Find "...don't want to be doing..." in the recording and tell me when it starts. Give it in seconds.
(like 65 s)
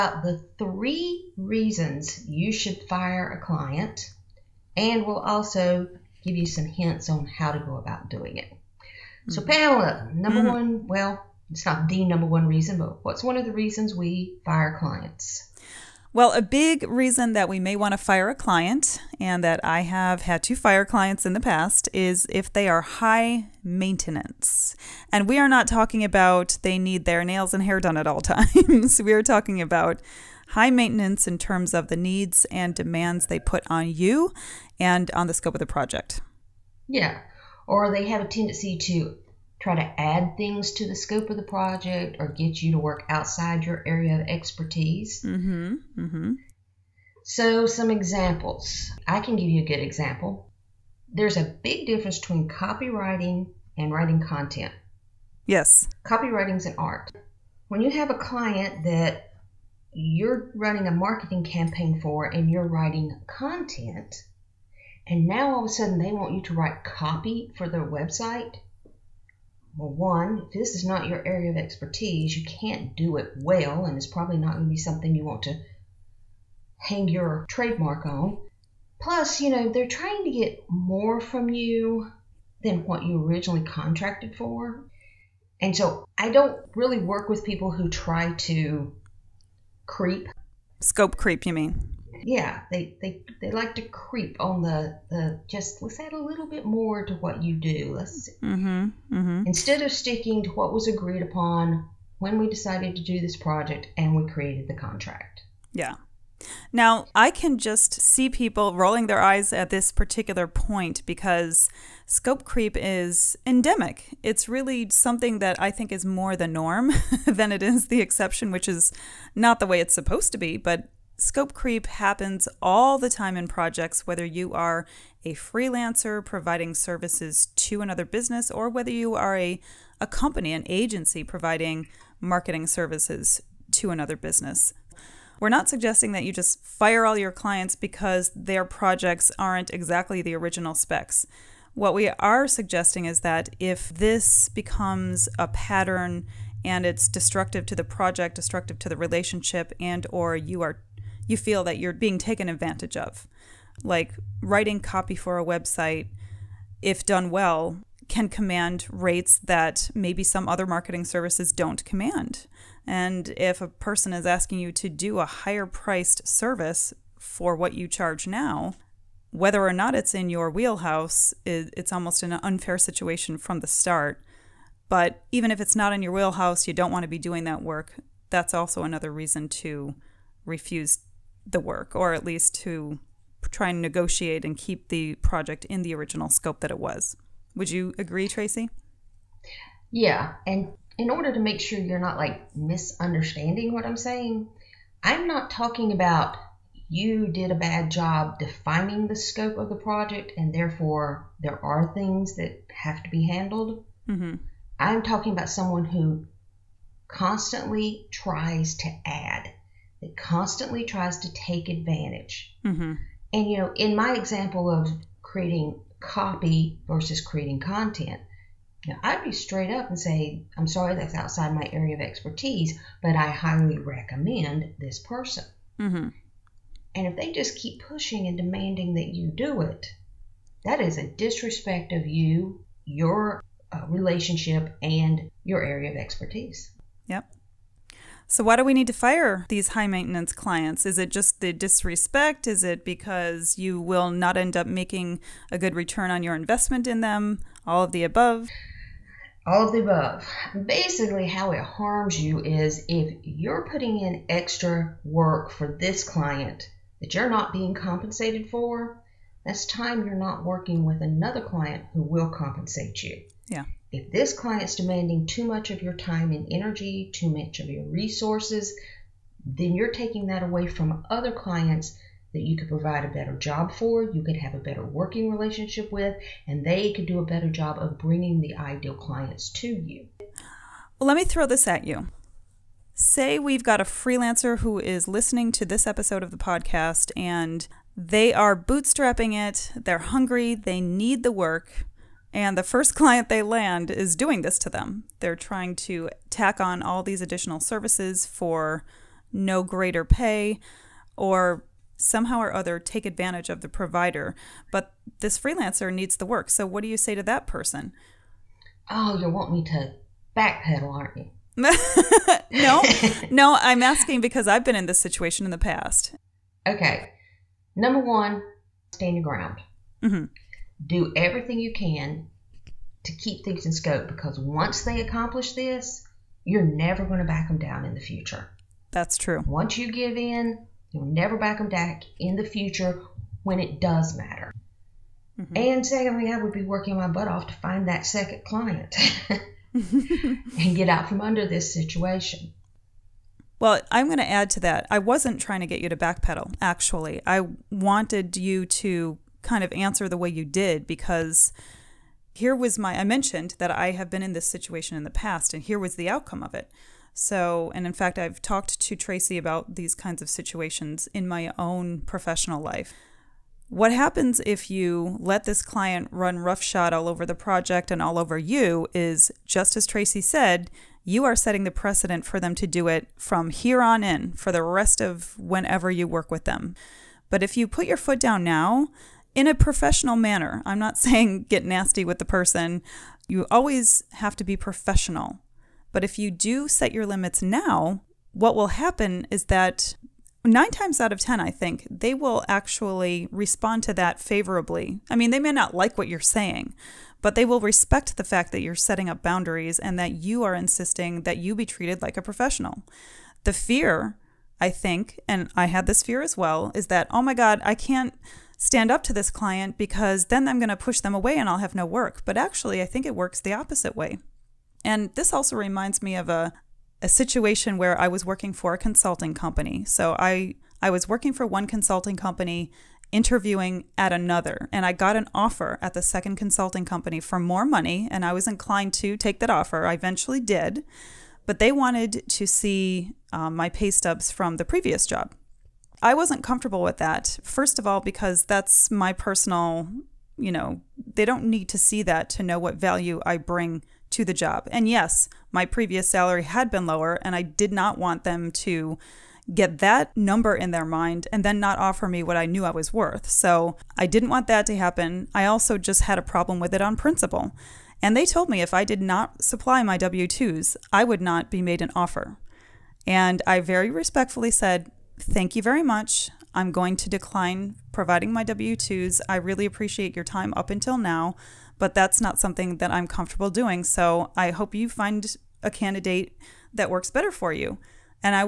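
176 s.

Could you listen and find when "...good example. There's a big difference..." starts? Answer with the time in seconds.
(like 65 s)
49 s.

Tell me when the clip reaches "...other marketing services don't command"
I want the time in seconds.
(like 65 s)
160 s.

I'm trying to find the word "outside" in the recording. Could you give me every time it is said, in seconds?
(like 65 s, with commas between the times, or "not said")
43 s, 221 s.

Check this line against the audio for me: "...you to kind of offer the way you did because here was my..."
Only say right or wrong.
wrong.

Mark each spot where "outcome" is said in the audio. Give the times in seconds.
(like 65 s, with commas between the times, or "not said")
356 s.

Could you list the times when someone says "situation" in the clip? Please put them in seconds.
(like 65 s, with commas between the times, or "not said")
172 s, 314 s, 341 s, 354 s, 360 s, 417 s.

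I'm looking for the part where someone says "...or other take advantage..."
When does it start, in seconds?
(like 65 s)
302 s.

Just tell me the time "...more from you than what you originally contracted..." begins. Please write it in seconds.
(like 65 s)
80 s.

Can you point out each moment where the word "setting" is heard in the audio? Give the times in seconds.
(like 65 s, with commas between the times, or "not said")
371 s, 398 s.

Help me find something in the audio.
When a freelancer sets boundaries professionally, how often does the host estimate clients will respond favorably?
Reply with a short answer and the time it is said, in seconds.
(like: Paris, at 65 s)
9 times out of 10, at 390 s.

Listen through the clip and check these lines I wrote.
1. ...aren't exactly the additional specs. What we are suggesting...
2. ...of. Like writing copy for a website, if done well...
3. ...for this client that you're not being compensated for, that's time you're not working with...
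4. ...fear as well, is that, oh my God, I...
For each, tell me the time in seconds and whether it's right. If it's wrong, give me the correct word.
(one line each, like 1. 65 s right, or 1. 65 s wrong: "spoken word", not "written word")
1. 139 s wrong: "original", not "additional"
2. 152 s right
3. 255 s right
4. 406 s right.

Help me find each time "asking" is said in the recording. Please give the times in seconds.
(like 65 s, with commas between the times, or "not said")
164 s, 313 s.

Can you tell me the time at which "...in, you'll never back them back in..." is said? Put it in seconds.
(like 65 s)
330 s.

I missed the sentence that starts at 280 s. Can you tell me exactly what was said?
Well, let me throw this at you.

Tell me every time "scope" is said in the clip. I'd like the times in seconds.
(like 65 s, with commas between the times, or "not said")
35 s, 40 s, 90 s, 112 s, 121 s, 186 s, 199 s, 323 s.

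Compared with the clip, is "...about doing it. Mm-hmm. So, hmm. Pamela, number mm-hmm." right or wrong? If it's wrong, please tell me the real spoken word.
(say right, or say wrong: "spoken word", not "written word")
right.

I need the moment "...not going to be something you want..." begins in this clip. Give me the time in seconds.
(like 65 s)
74 s.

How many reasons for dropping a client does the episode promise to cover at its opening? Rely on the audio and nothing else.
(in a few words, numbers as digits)
3.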